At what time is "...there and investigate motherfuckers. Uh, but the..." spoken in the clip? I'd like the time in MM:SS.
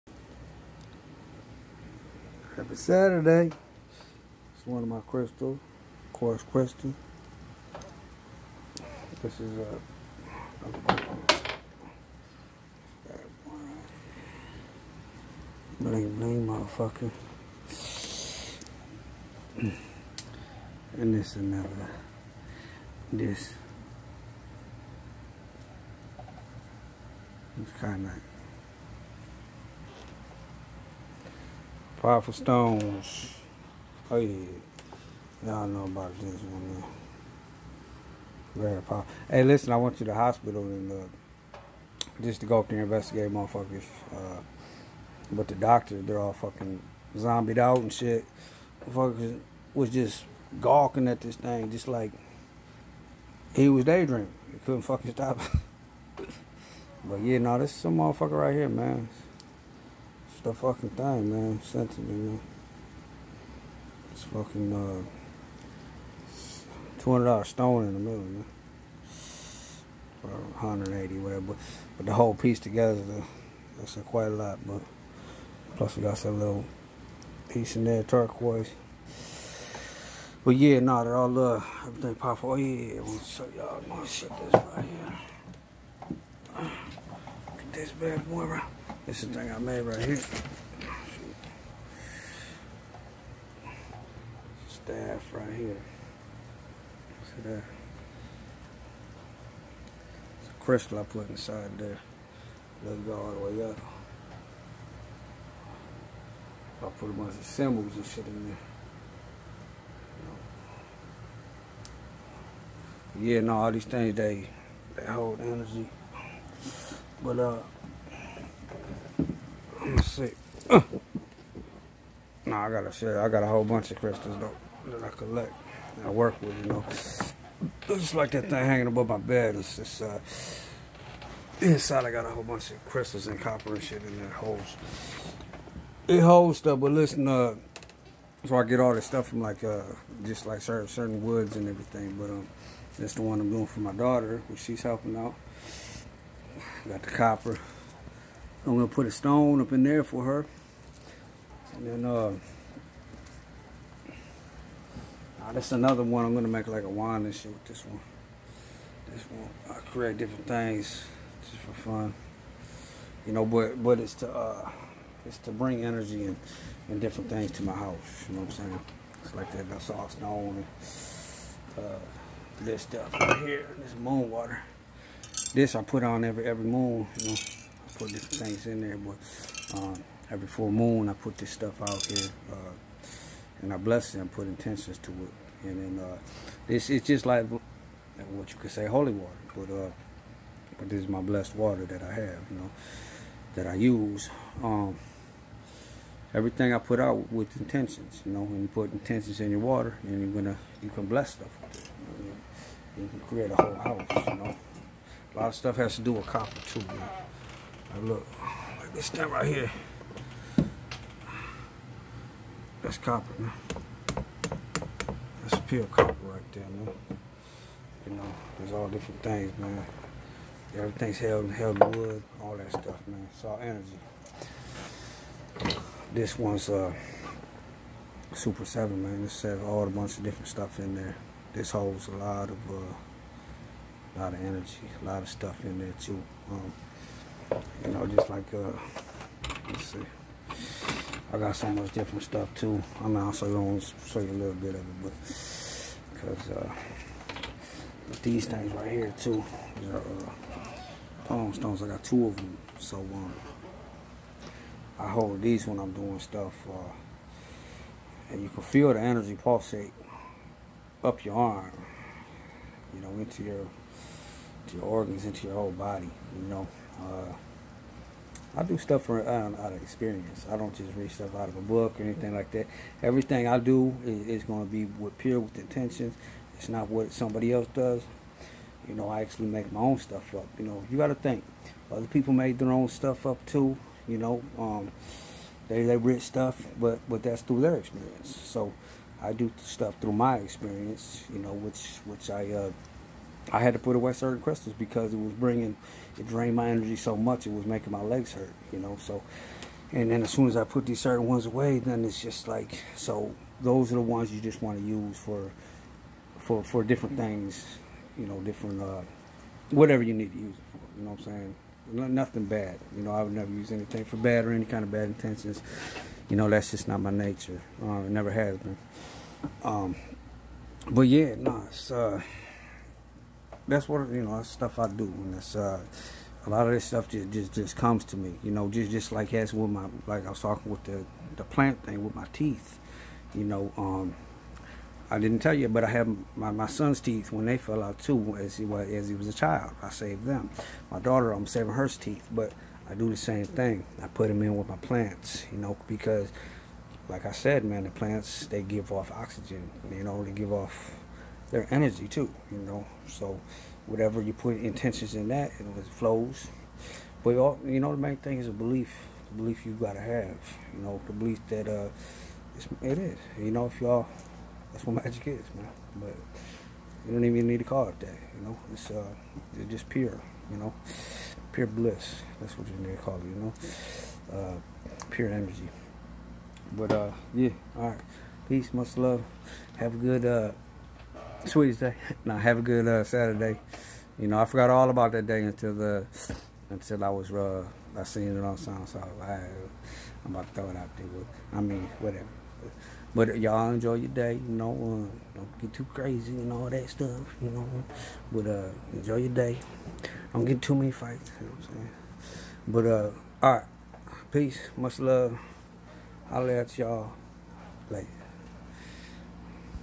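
00:42.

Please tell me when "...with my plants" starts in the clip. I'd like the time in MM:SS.
05:44.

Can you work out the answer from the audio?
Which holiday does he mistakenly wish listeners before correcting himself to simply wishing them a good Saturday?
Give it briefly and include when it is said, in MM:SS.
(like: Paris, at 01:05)
Sweetest Day, at 06:21.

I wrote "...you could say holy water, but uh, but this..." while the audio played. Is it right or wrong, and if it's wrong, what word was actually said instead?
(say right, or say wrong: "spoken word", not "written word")
right.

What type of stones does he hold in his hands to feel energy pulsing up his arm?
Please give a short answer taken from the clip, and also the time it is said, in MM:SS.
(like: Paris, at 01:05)
palm stones, at 04:11.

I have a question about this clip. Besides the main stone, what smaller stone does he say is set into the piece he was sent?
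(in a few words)
turquoise.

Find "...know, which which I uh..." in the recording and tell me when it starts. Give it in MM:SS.
04:51.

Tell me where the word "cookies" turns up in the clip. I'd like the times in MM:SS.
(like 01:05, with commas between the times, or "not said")
not said.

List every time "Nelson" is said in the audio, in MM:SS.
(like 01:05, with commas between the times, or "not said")
not said.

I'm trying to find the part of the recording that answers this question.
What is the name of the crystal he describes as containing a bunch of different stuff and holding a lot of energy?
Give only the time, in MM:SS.
03:48.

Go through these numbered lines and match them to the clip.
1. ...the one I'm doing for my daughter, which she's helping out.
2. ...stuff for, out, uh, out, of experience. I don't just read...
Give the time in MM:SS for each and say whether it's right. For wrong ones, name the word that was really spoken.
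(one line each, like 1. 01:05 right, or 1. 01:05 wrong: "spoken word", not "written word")
1. 02:23 right
2. 04:28 right.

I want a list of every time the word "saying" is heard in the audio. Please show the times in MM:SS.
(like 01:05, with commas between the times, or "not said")
02:48, 05:11, 06:41.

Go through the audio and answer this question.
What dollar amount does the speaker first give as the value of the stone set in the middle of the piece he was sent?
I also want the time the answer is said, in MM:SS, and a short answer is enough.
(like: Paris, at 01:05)
$200, at 01:07.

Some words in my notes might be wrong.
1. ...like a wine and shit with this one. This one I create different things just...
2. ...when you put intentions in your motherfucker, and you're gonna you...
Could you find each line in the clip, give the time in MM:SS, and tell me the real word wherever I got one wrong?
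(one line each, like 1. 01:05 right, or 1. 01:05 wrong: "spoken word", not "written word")
1. 02:36 right
2. 03:18 wrong: "water", not "motherfucker".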